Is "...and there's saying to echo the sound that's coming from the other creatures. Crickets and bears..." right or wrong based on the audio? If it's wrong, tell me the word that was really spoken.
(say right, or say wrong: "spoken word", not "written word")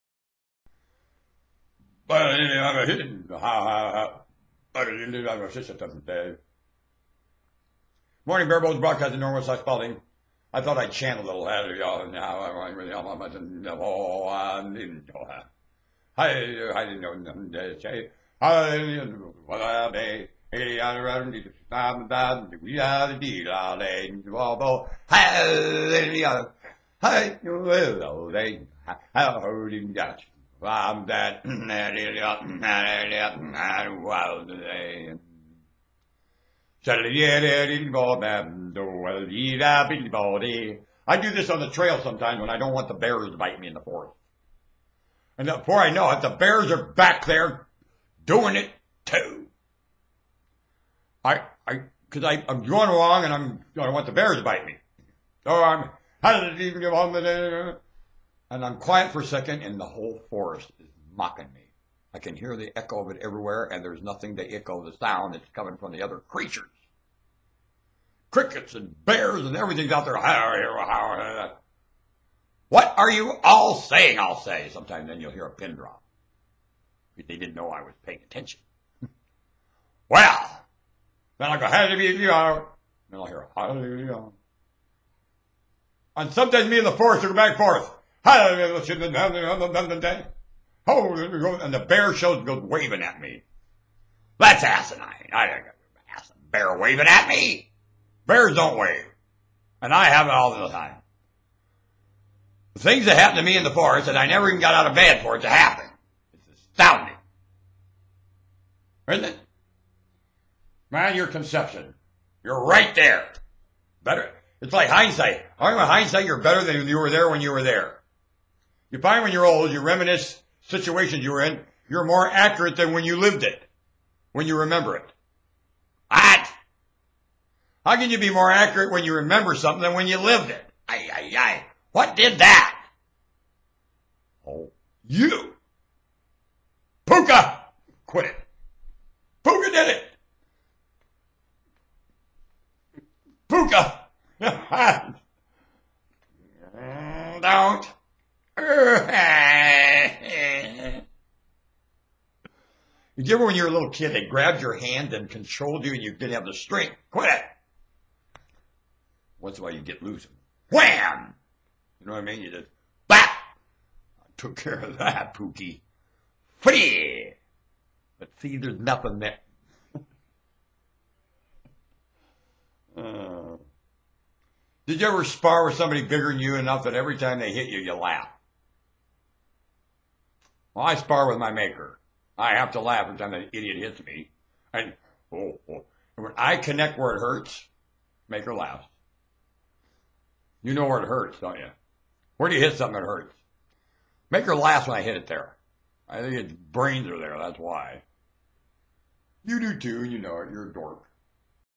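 wrong: "nothing", not "saying".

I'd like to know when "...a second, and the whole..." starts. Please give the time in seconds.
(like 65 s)
59 s.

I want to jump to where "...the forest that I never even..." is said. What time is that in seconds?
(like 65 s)
103 s.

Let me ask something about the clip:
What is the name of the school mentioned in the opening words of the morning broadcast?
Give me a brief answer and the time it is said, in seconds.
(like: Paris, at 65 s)
Norwest High Spalding, at 9 s.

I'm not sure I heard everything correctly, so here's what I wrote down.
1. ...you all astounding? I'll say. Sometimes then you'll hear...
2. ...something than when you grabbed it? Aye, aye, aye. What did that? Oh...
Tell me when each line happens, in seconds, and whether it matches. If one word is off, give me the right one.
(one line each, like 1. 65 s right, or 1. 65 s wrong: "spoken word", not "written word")
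1. 73 s wrong: "saying", not "astounding"
2. 129 s wrong: "lived", not "grabbed".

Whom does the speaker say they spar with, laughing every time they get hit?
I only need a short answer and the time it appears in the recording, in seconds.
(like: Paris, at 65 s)
My maker, at 181 s.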